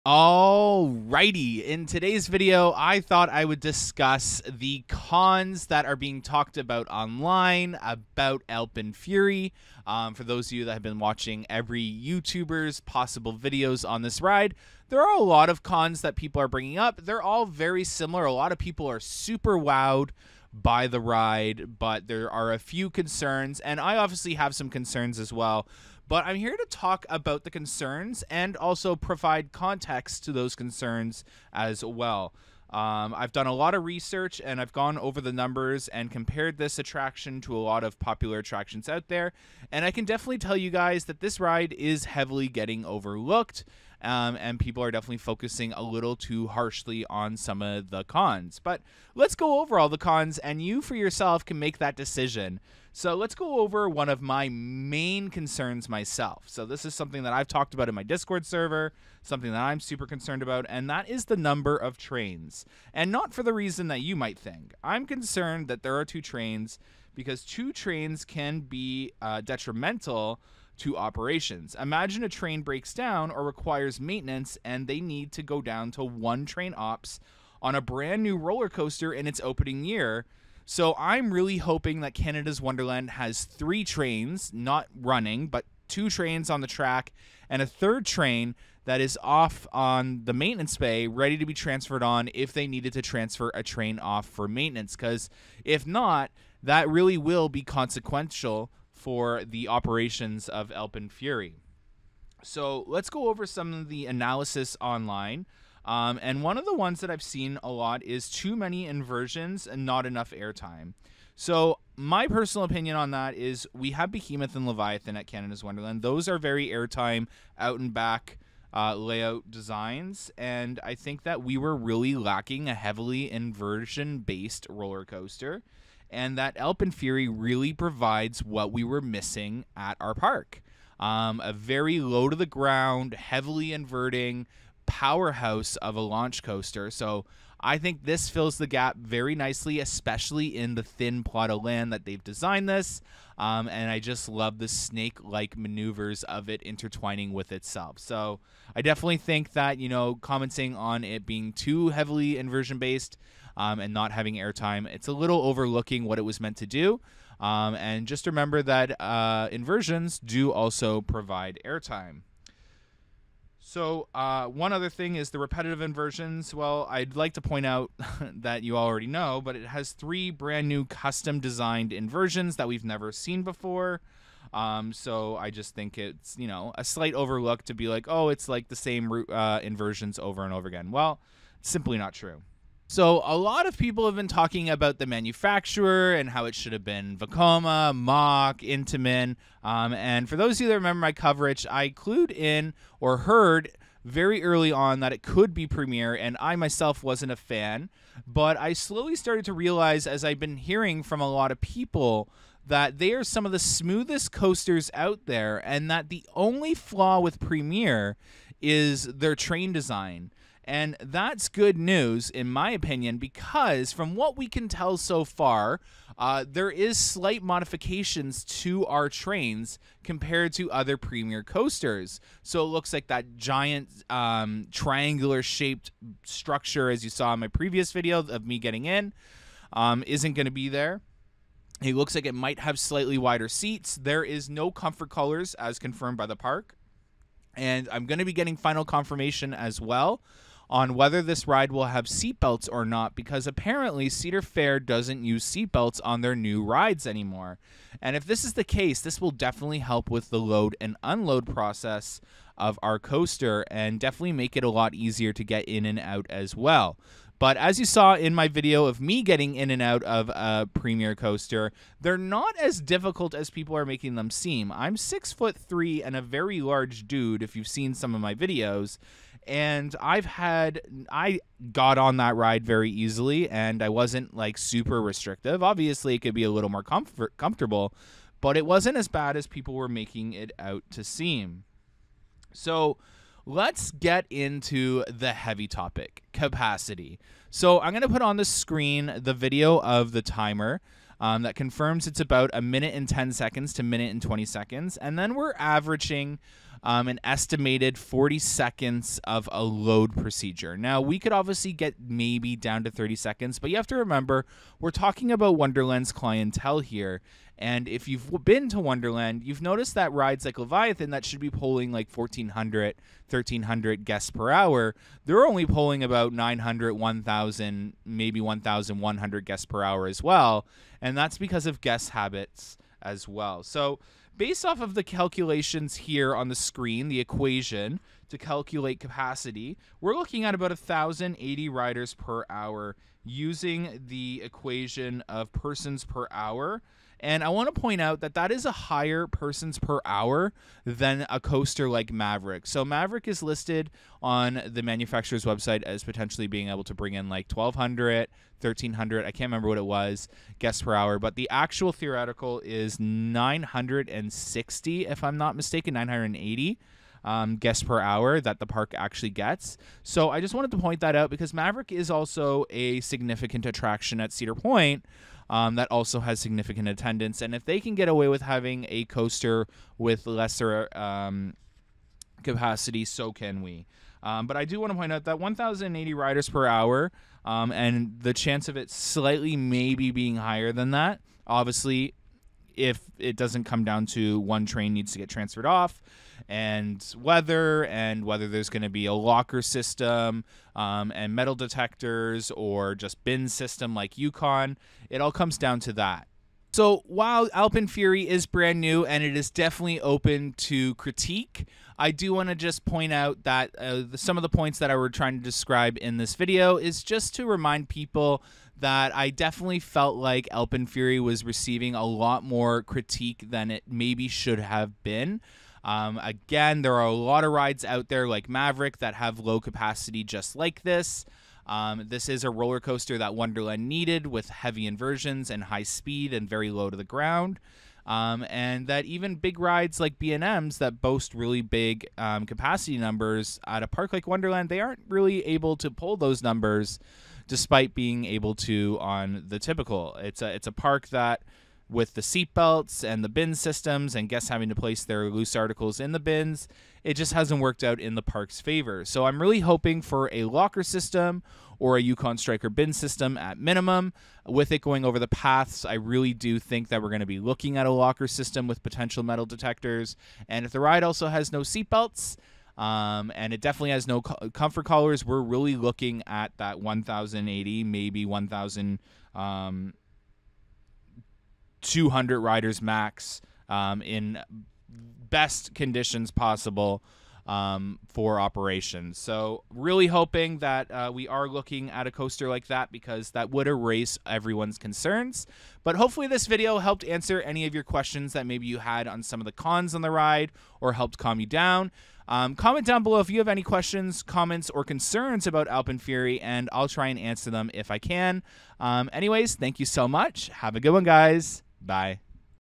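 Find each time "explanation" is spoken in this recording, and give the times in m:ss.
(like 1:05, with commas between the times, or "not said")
not said.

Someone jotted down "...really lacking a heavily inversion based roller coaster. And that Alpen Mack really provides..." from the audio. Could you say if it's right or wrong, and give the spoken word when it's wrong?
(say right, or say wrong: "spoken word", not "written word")
wrong: "Fury", not "Mack".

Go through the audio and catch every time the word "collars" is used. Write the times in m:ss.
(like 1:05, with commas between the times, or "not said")
3:55, 7:44.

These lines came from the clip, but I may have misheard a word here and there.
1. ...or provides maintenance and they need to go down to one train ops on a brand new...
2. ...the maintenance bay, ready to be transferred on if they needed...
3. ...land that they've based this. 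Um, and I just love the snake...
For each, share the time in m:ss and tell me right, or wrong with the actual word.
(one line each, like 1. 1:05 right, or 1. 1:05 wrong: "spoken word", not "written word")
1. 1:13 wrong: "requires", not "provides"
2. 1:30 right
3. 2:21 wrong: "designed", not "based".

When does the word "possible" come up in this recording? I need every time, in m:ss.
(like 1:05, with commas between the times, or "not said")
0:12, 7:56.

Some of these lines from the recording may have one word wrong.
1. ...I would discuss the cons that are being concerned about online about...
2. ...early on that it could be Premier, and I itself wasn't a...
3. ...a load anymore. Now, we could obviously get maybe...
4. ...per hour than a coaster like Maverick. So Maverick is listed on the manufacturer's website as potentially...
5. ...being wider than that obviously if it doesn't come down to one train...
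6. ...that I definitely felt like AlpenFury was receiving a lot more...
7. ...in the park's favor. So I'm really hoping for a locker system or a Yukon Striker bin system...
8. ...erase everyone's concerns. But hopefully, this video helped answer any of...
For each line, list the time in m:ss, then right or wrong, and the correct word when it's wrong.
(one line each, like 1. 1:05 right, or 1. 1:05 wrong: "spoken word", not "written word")
1. 0:03 wrong: "talked", not "concerned"
2. 3:14 wrong: "myself", not "itself"
3. 4:59 wrong: "procedure", not "anymore"
4. 5:39 right
5. 6:20 wrong: "higher", not "wider"
6. 6:48 right
7. 7:27 right
8. 8:03 right.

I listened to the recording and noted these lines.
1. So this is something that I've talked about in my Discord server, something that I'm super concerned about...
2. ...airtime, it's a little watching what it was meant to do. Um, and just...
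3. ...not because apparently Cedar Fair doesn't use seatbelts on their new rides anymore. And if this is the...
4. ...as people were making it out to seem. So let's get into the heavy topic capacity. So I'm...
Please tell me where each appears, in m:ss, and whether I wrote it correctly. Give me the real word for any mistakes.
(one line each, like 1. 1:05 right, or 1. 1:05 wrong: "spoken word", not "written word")
1. 0:56 right
2. 2:34 wrong: "overlooking", not "watching"
3. 4:02 right
4. 4:39 right.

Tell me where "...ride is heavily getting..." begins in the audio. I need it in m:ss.
0:41.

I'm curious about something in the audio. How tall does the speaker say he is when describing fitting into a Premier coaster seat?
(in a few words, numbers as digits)
6 foot 3.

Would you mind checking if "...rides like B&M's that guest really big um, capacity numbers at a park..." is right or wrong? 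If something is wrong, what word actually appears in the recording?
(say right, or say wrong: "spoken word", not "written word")
wrong: "boast", not "guest".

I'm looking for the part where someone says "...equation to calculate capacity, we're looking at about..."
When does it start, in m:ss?
5:27.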